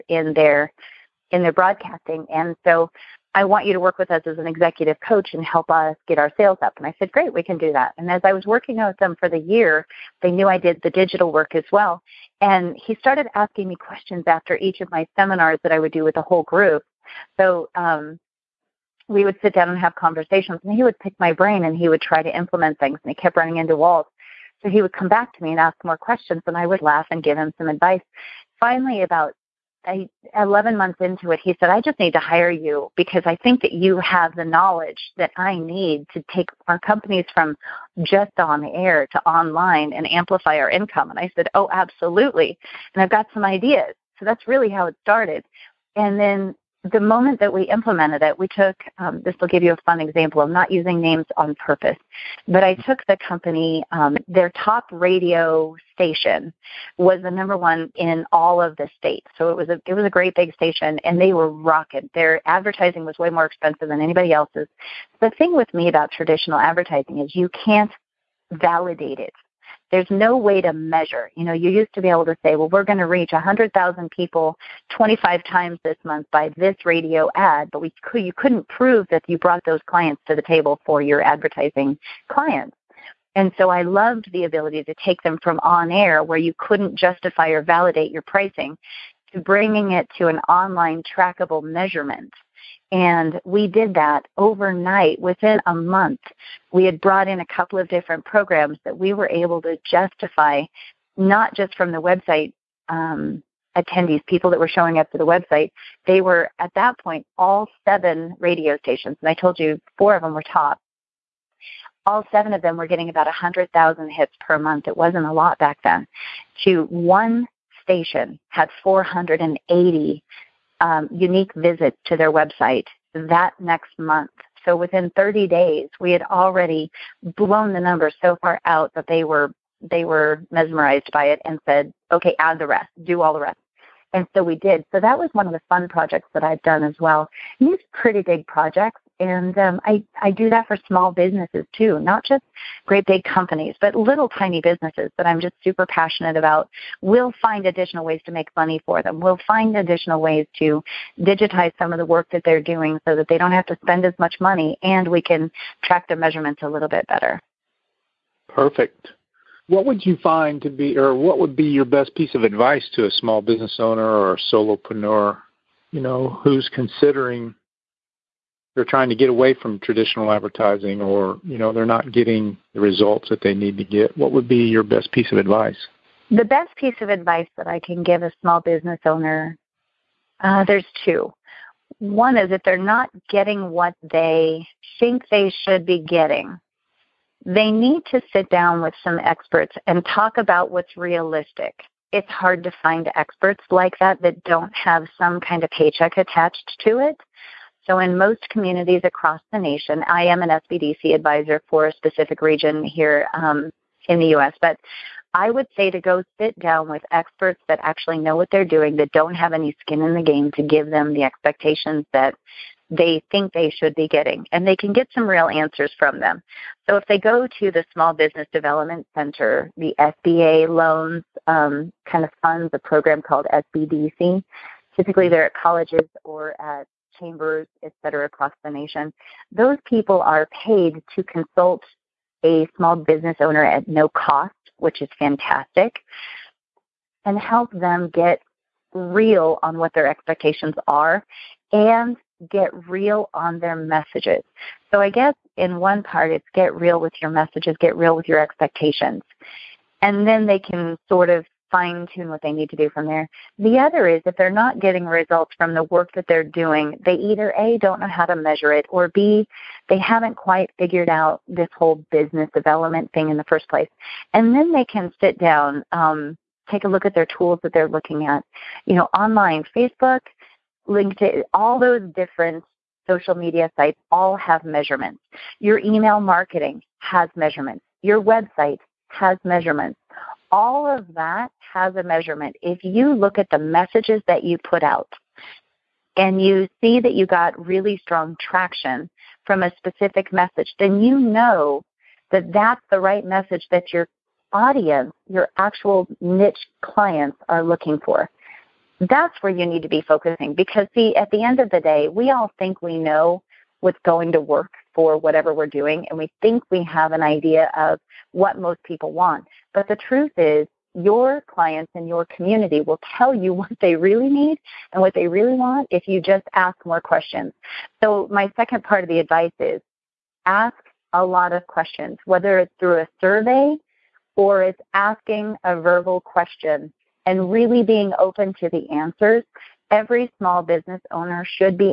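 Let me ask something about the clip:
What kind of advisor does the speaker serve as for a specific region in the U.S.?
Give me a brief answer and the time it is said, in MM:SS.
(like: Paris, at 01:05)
SBDC advisor, at 03:20.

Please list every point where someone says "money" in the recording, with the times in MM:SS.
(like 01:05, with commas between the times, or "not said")
02:28, 02:34.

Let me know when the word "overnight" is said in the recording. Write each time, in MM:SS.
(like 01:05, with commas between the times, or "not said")
01:34.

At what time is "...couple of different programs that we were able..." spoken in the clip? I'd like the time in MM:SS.
01:37.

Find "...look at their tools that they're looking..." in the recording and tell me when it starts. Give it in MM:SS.
04:26.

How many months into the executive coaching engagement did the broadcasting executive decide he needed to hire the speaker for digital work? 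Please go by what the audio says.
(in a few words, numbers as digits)
11.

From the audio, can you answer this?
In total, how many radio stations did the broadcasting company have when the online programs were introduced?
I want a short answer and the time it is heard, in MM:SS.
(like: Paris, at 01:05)
7, at 01:47.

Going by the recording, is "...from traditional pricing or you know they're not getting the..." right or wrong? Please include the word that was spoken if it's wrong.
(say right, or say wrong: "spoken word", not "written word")
wrong: "advertising", not "pricing".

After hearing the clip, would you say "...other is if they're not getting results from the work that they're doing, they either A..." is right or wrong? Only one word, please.
right.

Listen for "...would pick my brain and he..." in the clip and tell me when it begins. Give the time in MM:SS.
00:20.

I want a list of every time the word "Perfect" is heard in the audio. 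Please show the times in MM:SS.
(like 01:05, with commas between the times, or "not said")
02:38.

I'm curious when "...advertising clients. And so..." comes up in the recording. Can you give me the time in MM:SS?
01:21.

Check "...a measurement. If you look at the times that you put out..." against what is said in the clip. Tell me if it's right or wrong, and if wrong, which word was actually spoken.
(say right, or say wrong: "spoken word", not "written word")
wrong: "messages", not "times".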